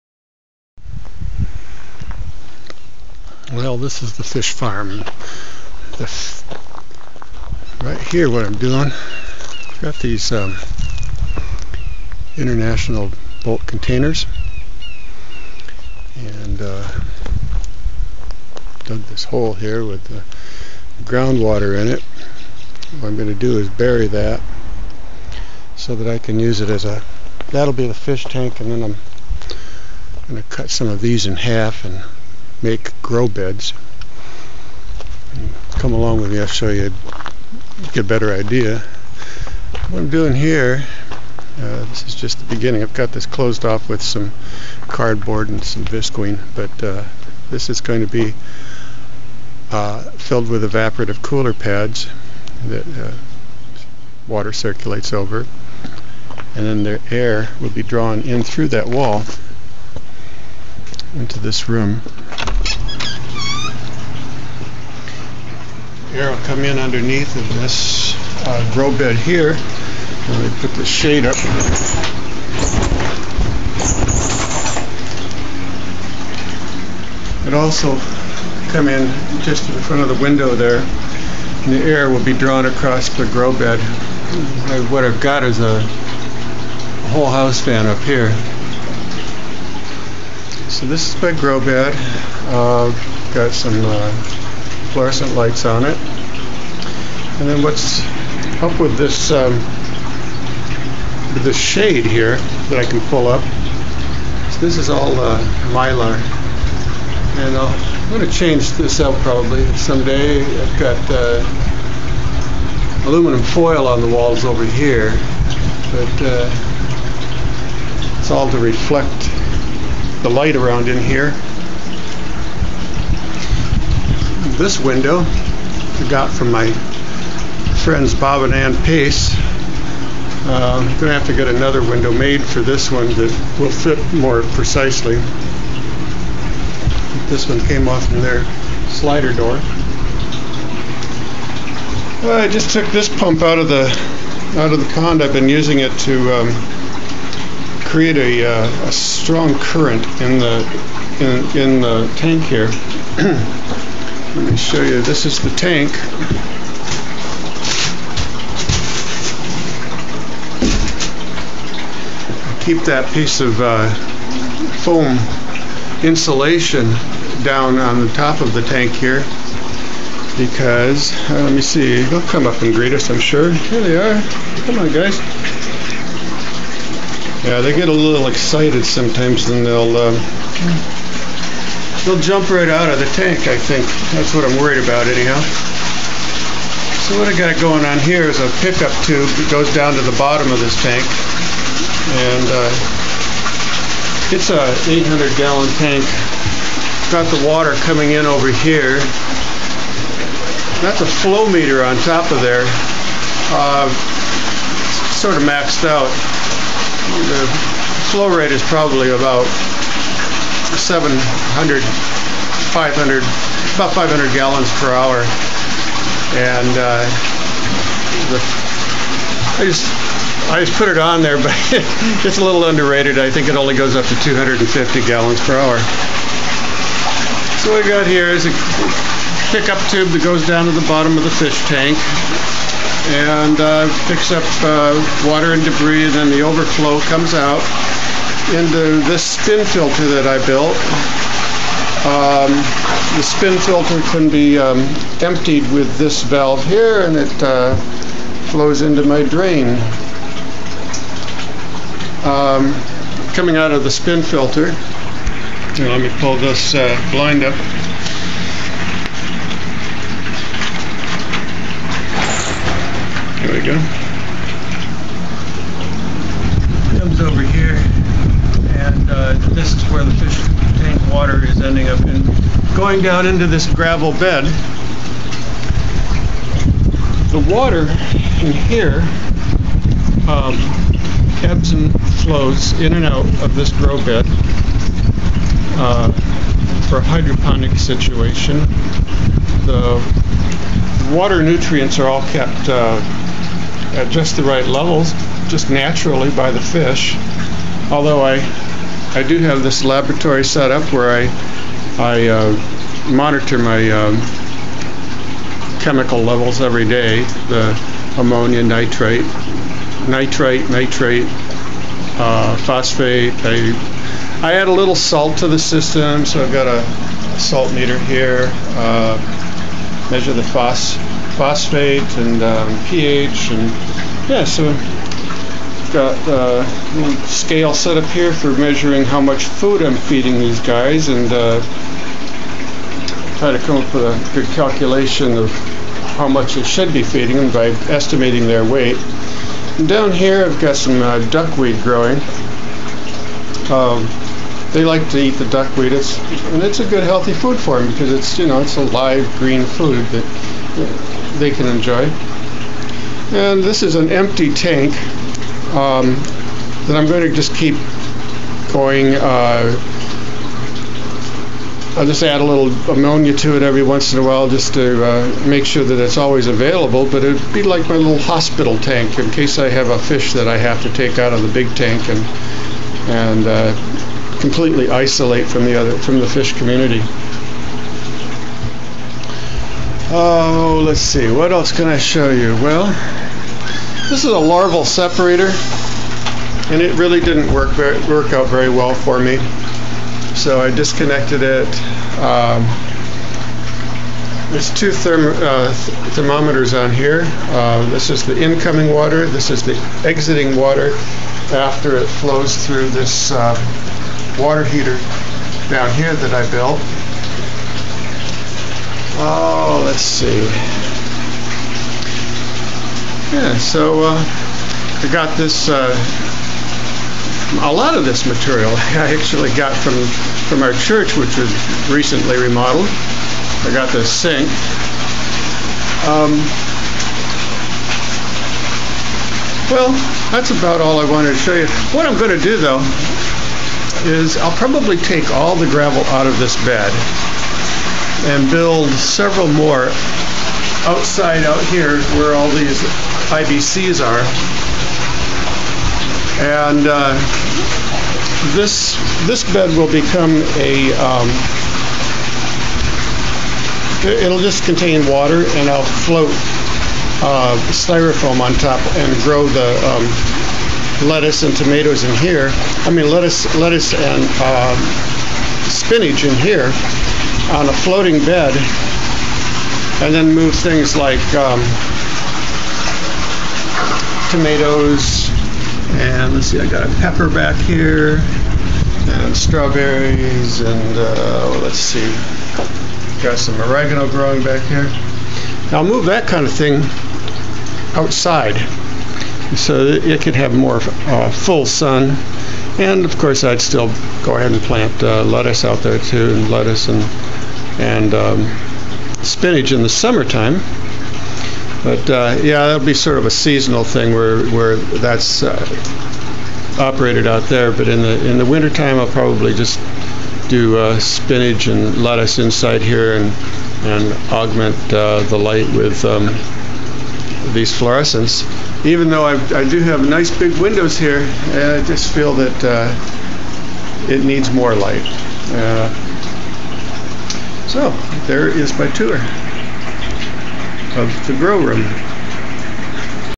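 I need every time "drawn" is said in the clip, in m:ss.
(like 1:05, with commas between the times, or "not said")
0:57, 1:22.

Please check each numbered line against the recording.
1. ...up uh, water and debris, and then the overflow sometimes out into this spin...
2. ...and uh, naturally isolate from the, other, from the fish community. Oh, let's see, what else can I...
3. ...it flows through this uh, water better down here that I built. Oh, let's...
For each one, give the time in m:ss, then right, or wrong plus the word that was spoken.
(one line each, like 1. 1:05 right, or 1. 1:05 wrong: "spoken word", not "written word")
1. 3:54 wrong: "comes", not "sometimes"
2. 6:13 wrong: "completely", not "naturally"
3. 6:41 wrong: "heater", not "better".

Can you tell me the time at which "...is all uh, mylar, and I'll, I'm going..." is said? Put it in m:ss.
1:44.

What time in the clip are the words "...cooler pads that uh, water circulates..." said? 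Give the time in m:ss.
0:51.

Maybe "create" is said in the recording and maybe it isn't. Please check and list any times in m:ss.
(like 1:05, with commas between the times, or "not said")
2:27.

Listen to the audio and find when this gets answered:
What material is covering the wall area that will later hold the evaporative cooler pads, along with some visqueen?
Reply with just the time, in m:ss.
0:44.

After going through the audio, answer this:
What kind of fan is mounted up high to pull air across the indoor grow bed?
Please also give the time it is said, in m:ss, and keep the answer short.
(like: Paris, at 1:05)
whole house fan, at 1:27.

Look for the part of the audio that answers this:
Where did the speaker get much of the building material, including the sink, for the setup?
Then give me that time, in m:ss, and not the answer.
7:00.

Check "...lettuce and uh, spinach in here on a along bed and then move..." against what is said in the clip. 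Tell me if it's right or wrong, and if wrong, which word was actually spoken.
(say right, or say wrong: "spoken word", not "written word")
wrong: "floating", not "along".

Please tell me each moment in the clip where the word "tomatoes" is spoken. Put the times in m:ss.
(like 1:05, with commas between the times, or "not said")
7:41, 7:54.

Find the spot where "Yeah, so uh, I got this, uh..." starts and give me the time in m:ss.
6:53.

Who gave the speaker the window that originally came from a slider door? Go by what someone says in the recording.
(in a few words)
Bob and Ann Pace.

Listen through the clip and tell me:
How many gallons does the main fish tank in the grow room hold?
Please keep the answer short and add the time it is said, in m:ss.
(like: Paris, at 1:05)
800, at 3:14.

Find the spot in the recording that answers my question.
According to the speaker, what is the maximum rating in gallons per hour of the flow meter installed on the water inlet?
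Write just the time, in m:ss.
3:44.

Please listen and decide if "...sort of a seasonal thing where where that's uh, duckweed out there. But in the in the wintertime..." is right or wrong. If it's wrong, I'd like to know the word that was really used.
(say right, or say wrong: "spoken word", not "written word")
wrong: "operated", not "duckweed".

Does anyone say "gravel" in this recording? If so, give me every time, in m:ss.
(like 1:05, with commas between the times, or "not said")
4:33, 7:15.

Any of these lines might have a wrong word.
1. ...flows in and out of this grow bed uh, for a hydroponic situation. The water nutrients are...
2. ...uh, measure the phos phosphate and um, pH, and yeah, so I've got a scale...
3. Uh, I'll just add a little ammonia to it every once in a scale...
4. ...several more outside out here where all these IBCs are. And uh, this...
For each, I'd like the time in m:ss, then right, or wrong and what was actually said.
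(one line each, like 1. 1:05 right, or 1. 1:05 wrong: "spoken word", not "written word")
1. 4:42 right
2. 5:18 right
3. 5:59 wrong: "while", not "scale"
4. 7:18 right.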